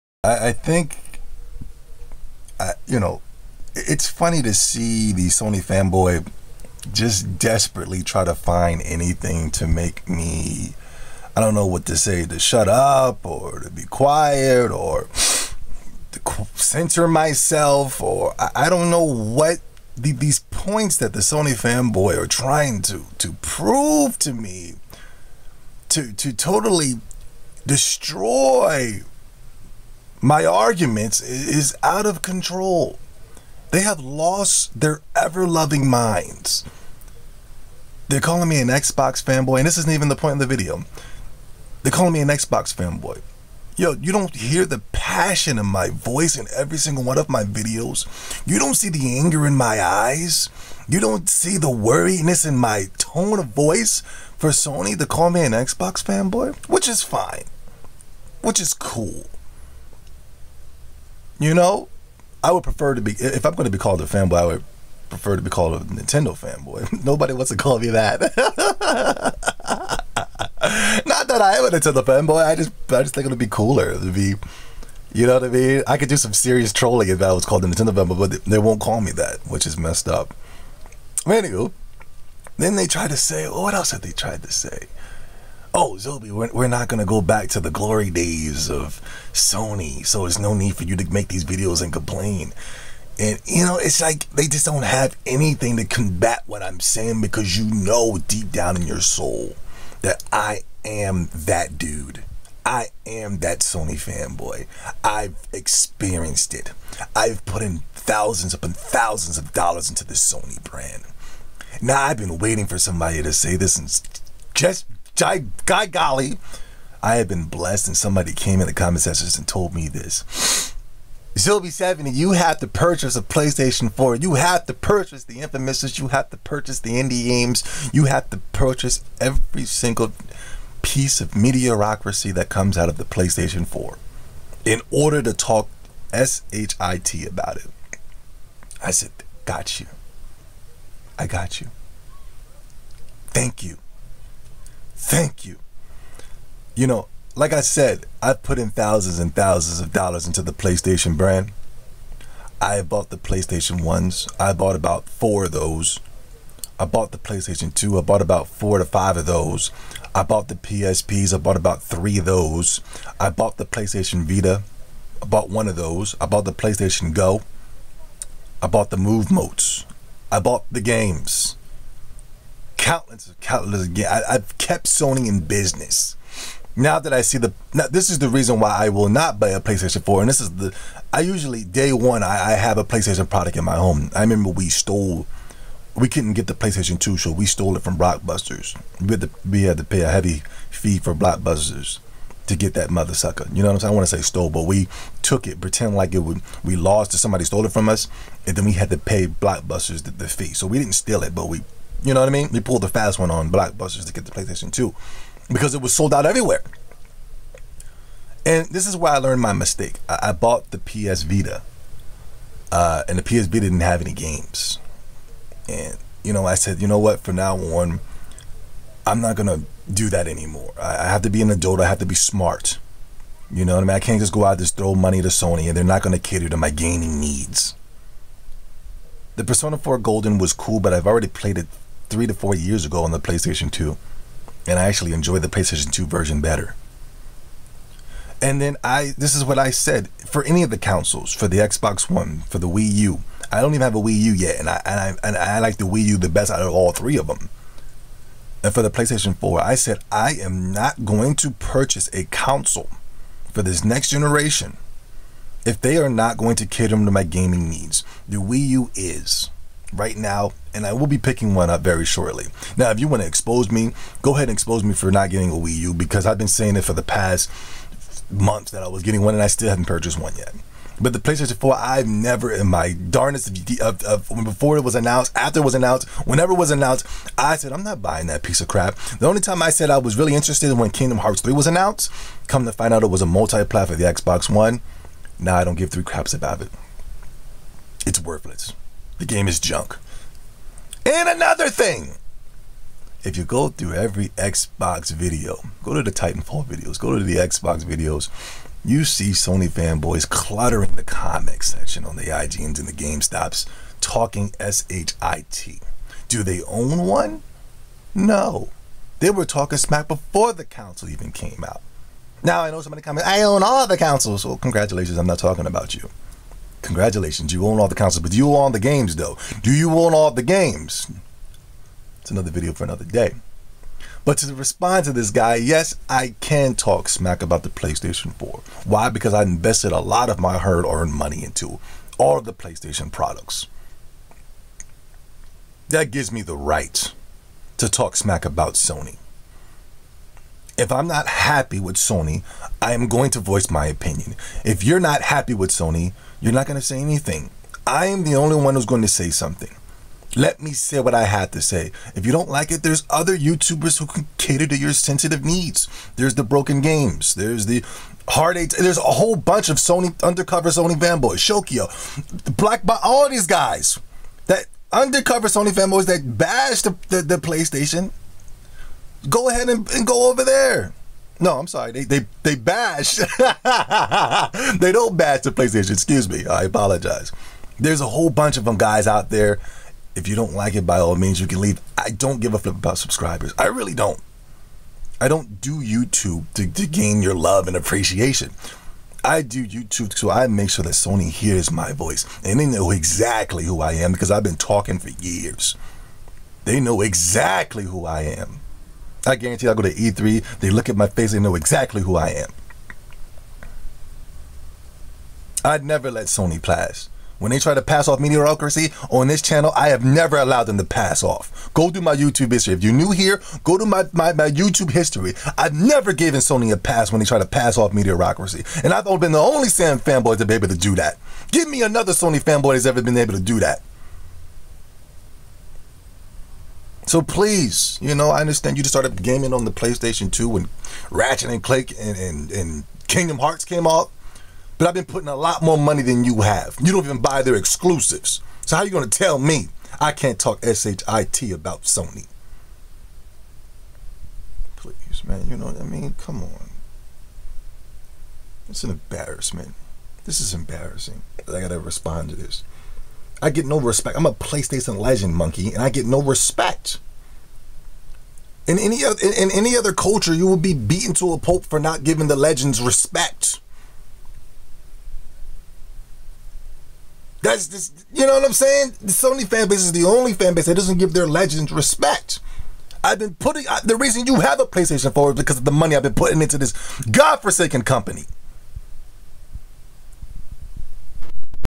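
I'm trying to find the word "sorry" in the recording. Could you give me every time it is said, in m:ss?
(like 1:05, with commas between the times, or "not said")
6:11.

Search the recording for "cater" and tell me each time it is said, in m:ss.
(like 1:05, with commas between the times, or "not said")
3:46, 4:16, 5:54.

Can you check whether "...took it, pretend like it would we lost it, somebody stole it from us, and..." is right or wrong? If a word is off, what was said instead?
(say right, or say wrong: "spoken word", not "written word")
right.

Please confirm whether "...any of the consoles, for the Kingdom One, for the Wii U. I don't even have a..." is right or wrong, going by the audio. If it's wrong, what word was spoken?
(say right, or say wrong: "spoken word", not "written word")
wrong: "Xbox", not "Kingdom".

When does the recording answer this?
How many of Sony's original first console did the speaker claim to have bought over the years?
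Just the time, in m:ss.
2:34.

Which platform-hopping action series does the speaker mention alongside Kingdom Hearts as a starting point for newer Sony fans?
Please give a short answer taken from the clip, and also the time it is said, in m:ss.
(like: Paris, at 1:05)
Ratchet and Clank, at 7:11.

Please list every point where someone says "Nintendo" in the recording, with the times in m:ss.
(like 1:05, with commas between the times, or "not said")
1:05, 1:11, 1:17.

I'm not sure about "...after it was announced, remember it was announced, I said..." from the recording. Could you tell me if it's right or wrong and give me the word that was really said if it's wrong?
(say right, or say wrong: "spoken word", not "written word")
wrong: "whenever", not "remember".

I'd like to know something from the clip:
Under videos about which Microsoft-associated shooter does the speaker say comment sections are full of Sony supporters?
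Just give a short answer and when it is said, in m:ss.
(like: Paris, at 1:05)
Titanfall, at 4:56.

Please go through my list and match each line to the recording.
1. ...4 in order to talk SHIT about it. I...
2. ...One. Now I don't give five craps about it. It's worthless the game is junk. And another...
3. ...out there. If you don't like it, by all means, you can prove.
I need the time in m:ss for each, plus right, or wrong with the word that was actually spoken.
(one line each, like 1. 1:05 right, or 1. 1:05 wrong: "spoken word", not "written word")
1. 2:13 right
2. 4:44 wrong: "three", not "five"
3. 6:19 wrong: "leave", not "prove".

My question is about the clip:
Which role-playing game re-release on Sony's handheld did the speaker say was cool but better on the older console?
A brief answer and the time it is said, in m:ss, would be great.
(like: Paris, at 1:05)
Persona 4 Golden, at 3:49.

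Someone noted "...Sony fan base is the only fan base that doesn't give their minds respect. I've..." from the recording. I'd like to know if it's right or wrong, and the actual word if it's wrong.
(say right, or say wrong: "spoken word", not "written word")
wrong: "legends", not "minds".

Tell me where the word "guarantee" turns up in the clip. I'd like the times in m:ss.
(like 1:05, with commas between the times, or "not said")
6:39.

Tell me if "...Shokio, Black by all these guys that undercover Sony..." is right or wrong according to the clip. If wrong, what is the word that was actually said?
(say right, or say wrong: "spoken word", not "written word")
right.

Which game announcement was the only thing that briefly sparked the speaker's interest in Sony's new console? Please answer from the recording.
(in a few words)
Kingdom Hearts 3.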